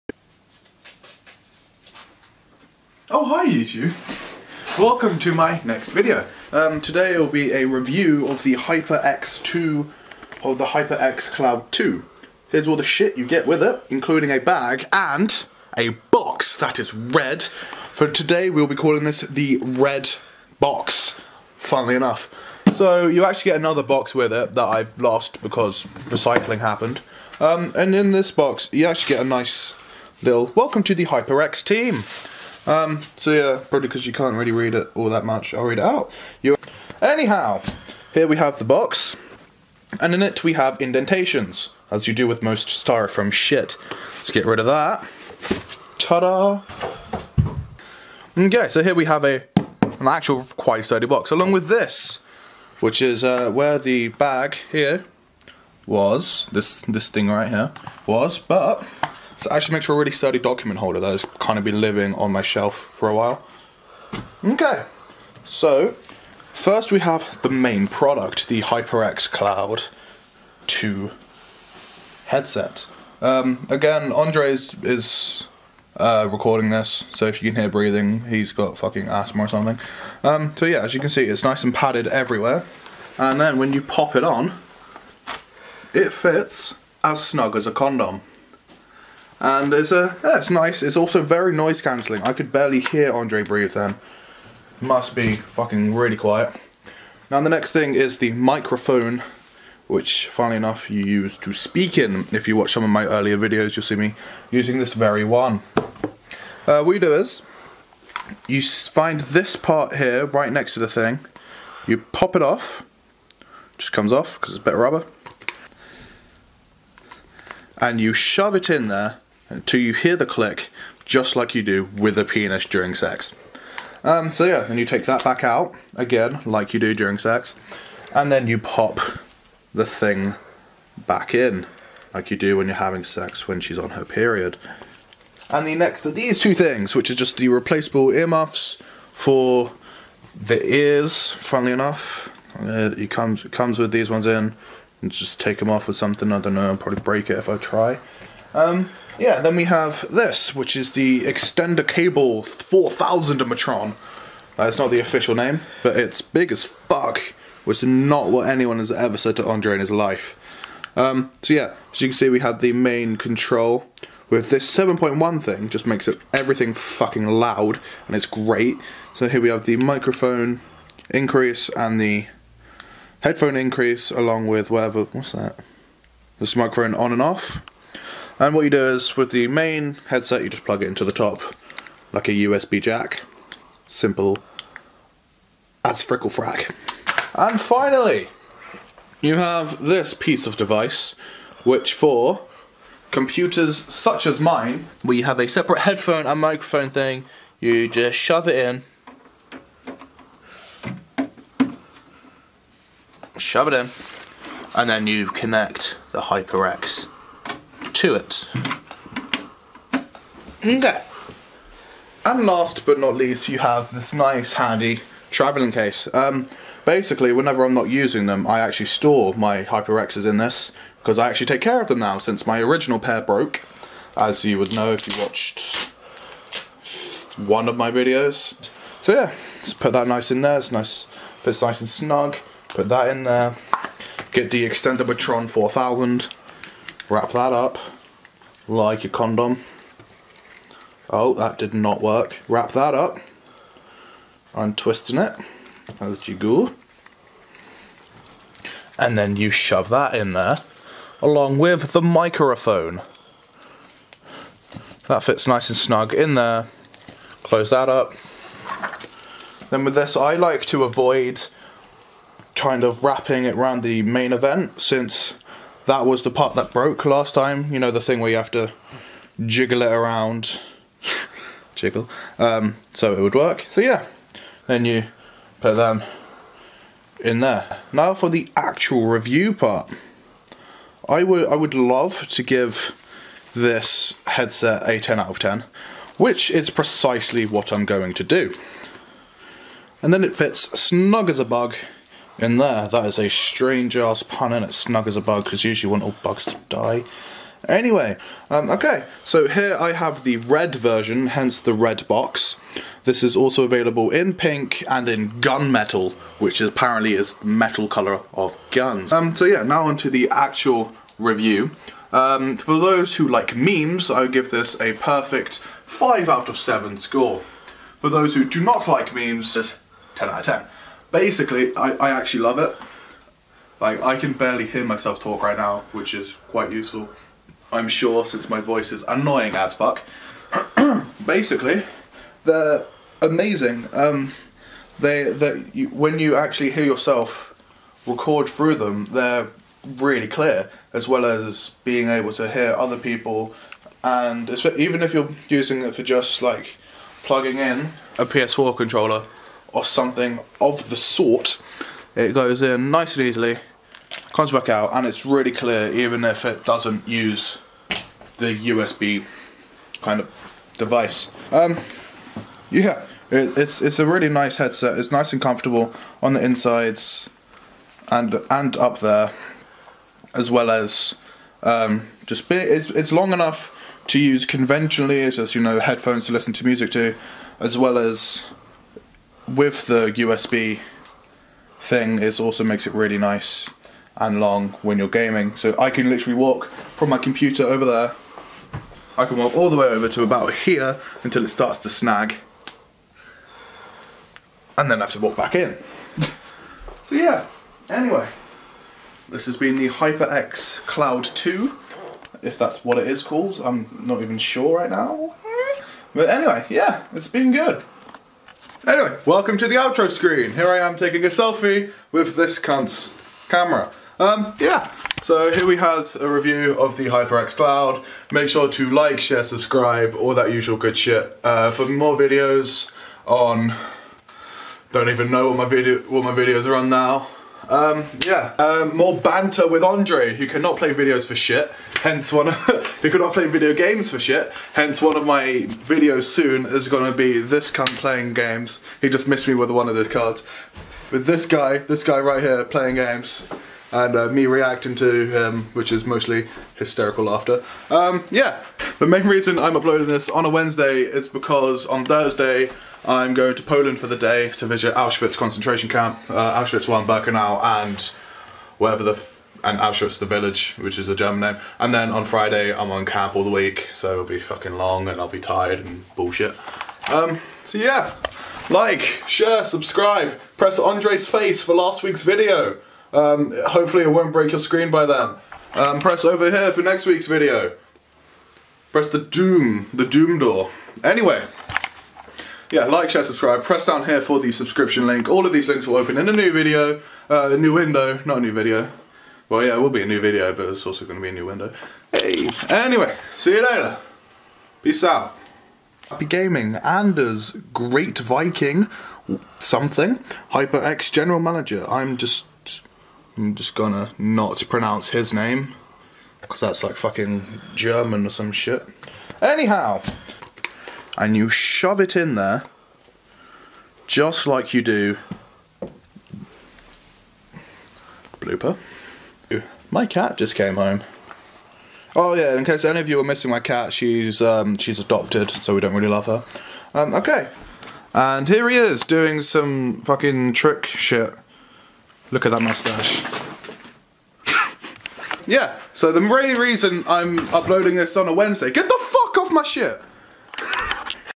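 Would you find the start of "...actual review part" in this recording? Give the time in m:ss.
4:38.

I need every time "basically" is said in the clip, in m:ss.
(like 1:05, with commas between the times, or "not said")
3:36, 5:21, 5:31.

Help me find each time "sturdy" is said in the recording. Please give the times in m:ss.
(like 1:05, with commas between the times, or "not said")
0:50, 1:00.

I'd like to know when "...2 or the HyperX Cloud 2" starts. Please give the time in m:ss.
0:09.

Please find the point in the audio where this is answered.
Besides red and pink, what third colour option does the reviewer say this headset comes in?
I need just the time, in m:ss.
5:05.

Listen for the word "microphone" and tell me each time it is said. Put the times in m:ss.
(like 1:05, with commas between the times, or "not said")
1:38, 2:49, 2:56, 3:16, 4:12.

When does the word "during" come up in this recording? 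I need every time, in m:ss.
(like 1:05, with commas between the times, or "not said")
2:02, 2:06.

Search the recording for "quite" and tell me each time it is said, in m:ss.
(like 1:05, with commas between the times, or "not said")
0:50, 5:26.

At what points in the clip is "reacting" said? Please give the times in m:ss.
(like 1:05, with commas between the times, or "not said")
7:24.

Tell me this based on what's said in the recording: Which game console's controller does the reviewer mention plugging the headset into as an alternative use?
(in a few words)
PS4.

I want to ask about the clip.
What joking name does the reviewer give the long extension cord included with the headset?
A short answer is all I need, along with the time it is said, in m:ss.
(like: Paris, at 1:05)
Extender Cable 4000 Matron, at 2:31.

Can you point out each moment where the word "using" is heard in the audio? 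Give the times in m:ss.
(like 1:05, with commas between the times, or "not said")
1:44, 3:37, 5:45.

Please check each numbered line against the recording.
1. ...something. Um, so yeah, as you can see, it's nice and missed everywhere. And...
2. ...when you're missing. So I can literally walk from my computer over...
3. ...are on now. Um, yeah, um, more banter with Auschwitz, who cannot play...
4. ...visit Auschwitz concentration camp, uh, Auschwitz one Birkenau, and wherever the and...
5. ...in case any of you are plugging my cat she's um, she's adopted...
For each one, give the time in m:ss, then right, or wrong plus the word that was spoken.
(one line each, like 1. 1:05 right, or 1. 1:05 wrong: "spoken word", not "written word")
1. 1:19 wrong: "padded", not "missed"
2. 6:24 wrong: "gaming", not "missing"
3. 7:06 wrong: "Andre", not "Auschwitz"
4. 7:34 right
5. 8:42 wrong: "missing", not "plugging".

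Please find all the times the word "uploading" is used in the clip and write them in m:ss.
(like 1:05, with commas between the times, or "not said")
7:29, 8:57.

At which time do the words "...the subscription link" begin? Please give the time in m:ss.
8:04.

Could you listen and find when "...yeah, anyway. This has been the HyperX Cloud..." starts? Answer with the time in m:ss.
6:37.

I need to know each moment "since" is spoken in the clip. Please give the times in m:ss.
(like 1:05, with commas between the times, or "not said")
3:42, 4:24, 5:28.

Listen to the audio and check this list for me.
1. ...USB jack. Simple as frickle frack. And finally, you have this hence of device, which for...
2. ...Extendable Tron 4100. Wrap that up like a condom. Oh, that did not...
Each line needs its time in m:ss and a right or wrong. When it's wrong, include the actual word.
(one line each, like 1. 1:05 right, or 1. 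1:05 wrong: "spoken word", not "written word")
1. 3:02 wrong: "piece", not "hence"
2. 3:54 wrong: "4000", not "4100".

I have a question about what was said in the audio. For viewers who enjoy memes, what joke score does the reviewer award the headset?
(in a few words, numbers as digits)
5 out of 7.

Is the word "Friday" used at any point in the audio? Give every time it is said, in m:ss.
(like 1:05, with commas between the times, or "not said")
7:42.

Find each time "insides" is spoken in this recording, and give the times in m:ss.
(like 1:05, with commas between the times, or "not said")
6:06.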